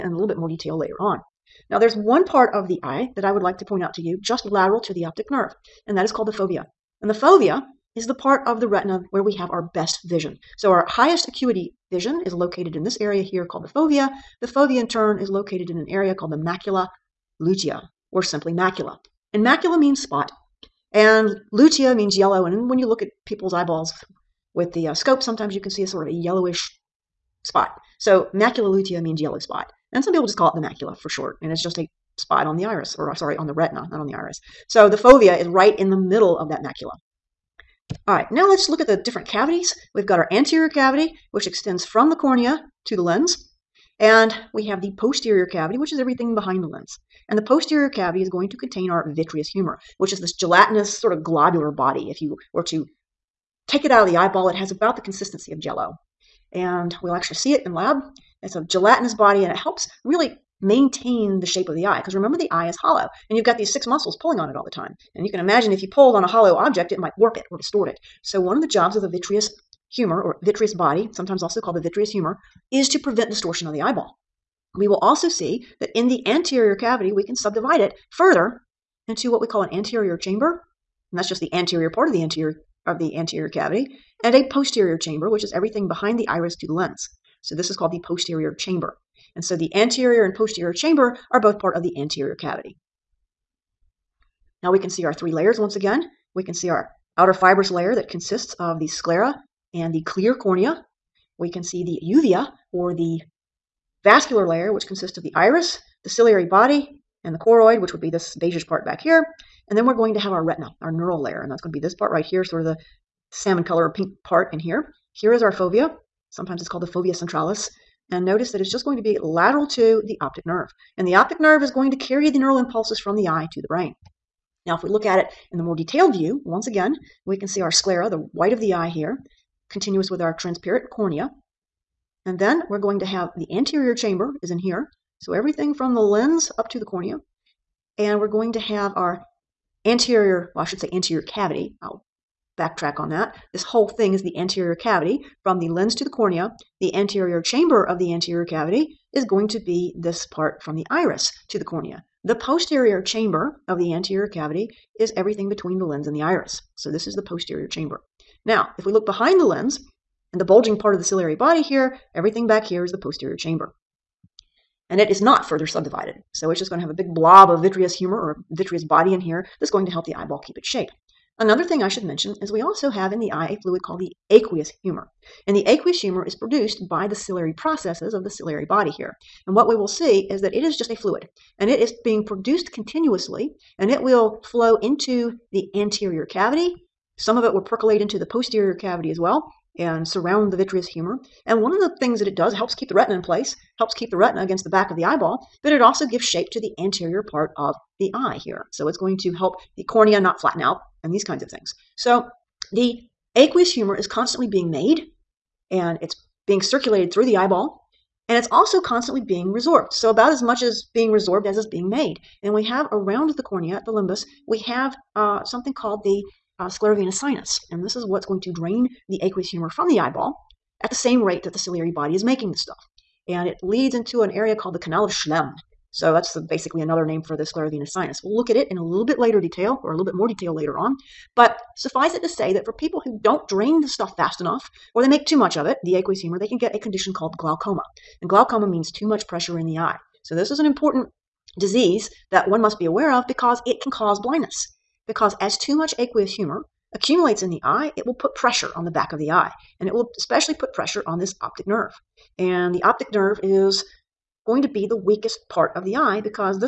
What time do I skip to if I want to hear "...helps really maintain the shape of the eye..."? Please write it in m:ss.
0:59.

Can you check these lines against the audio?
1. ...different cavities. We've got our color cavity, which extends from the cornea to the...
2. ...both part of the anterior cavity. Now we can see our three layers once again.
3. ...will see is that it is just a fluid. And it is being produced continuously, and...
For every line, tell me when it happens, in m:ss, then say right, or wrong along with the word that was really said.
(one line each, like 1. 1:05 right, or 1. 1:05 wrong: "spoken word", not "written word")
1. 0:38 wrong: "anterior", not "color"
2. 1:31 right
3. 2:59 right.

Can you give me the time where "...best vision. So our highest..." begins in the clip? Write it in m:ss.
0:09.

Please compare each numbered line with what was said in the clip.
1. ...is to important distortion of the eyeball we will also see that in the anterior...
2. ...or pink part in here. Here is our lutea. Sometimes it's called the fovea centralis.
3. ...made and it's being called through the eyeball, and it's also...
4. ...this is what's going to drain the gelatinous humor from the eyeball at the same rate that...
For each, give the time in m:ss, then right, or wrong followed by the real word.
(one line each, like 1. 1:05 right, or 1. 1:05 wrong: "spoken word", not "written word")
1. 1:12 wrong: "prevent", not "important"
2. 1:53 wrong: "fovea", not "lutea"
3. 3:24 wrong: "circulated", not "called"
4. 3:37 wrong: "aqueous", not "gelatinous".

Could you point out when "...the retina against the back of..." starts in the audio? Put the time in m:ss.
3:14.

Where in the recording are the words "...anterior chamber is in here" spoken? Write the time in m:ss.
2:13.